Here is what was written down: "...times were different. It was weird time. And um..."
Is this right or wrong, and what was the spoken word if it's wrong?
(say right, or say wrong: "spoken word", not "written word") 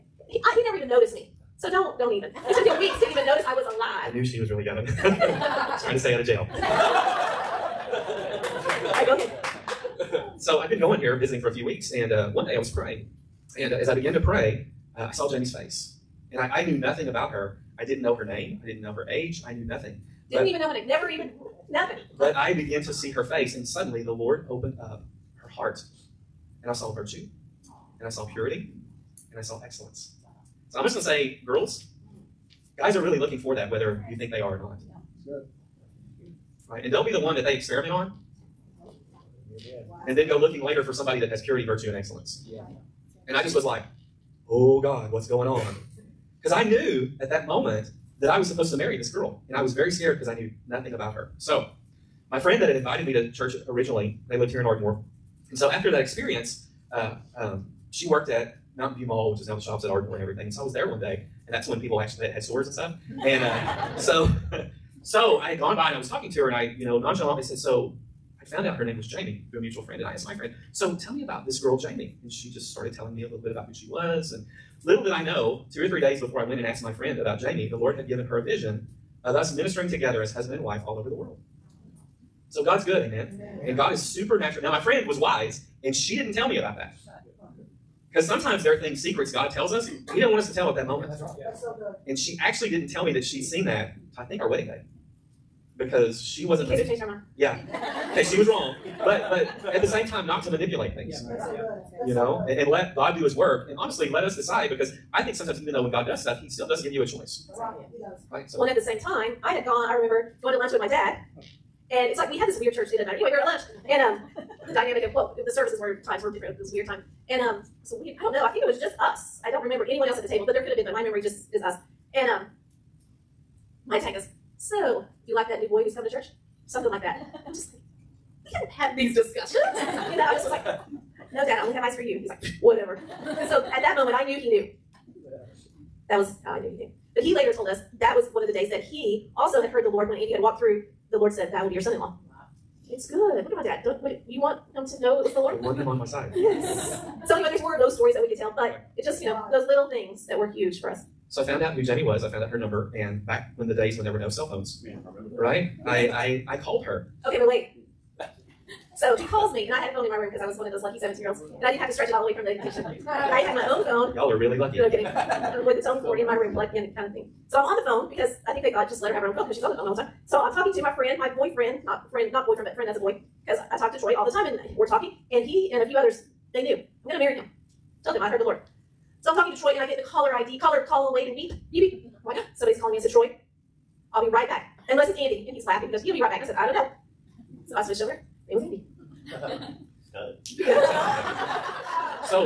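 right.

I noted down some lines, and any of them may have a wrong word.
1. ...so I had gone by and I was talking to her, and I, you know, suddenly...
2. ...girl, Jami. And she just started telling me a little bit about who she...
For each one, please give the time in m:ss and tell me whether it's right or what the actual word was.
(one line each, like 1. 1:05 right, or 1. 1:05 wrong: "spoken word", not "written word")
1. 1:05 wrong: "nonchalantly", not "suddenly"
2. 1:11 right.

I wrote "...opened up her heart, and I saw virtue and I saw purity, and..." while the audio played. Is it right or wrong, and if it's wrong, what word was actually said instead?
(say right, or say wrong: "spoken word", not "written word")
right.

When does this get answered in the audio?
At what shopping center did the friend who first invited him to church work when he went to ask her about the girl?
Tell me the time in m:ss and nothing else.
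0:58.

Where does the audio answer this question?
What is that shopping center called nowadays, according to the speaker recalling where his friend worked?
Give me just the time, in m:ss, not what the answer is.
0:59.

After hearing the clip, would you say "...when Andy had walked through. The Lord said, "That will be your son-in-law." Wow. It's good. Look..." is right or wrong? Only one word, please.
right.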